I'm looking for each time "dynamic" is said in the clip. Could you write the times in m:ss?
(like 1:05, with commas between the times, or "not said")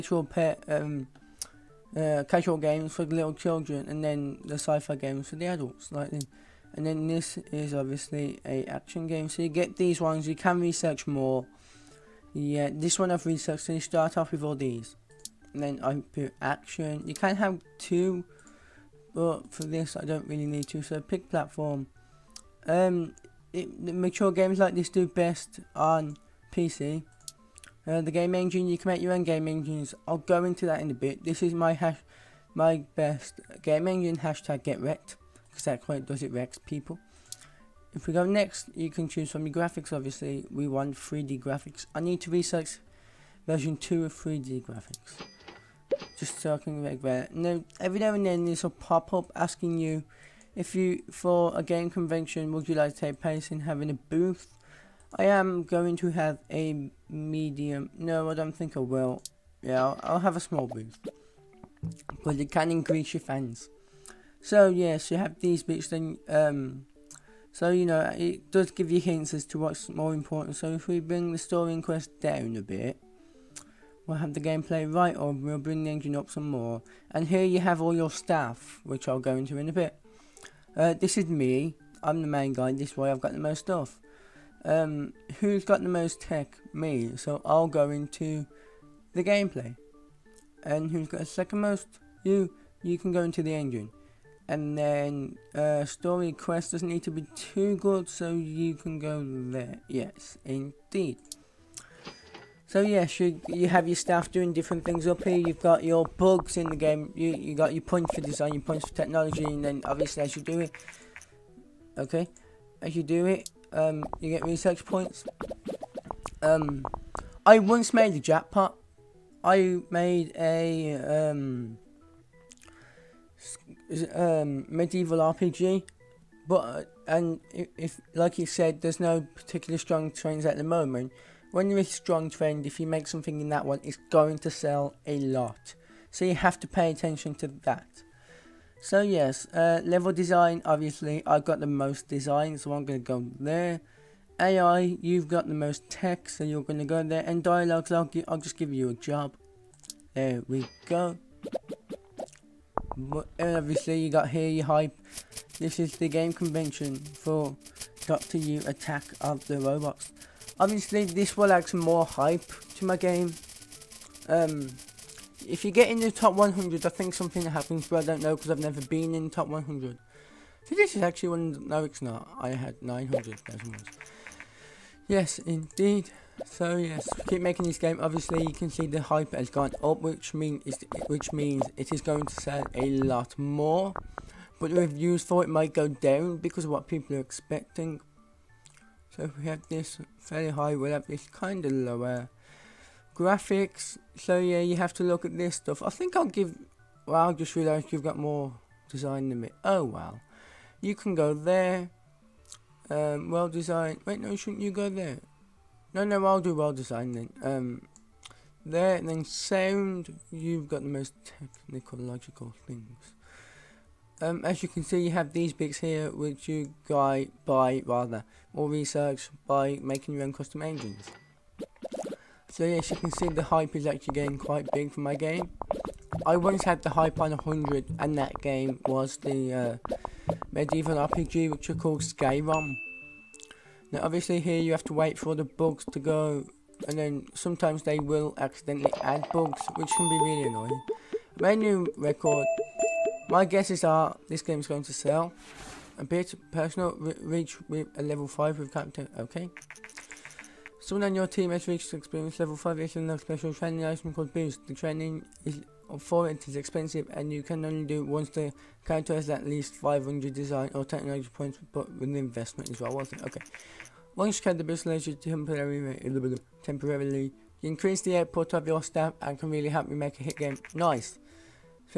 not said.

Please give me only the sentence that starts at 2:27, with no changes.
And dialogues, I'll, I'll just give you a job.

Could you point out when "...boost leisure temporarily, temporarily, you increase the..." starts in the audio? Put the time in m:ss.
4:24.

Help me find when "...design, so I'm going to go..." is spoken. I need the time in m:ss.
2:22.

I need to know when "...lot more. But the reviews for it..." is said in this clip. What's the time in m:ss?
3:02.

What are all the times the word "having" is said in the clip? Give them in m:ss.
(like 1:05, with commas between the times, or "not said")
0:53.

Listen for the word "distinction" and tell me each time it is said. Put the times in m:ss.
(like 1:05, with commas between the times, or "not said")
not said.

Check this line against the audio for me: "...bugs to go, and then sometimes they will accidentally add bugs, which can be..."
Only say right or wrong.
right.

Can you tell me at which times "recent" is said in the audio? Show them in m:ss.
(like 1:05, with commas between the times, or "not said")
not said.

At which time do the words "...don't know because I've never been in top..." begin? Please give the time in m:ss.
2:48.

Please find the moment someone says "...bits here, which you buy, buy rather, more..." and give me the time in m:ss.
3:35.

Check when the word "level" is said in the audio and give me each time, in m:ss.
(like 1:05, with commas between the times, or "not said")
2:19, 4:08, 4:12.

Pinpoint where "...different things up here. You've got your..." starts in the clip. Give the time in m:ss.
1:44.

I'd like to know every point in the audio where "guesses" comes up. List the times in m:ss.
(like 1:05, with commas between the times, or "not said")
4:03.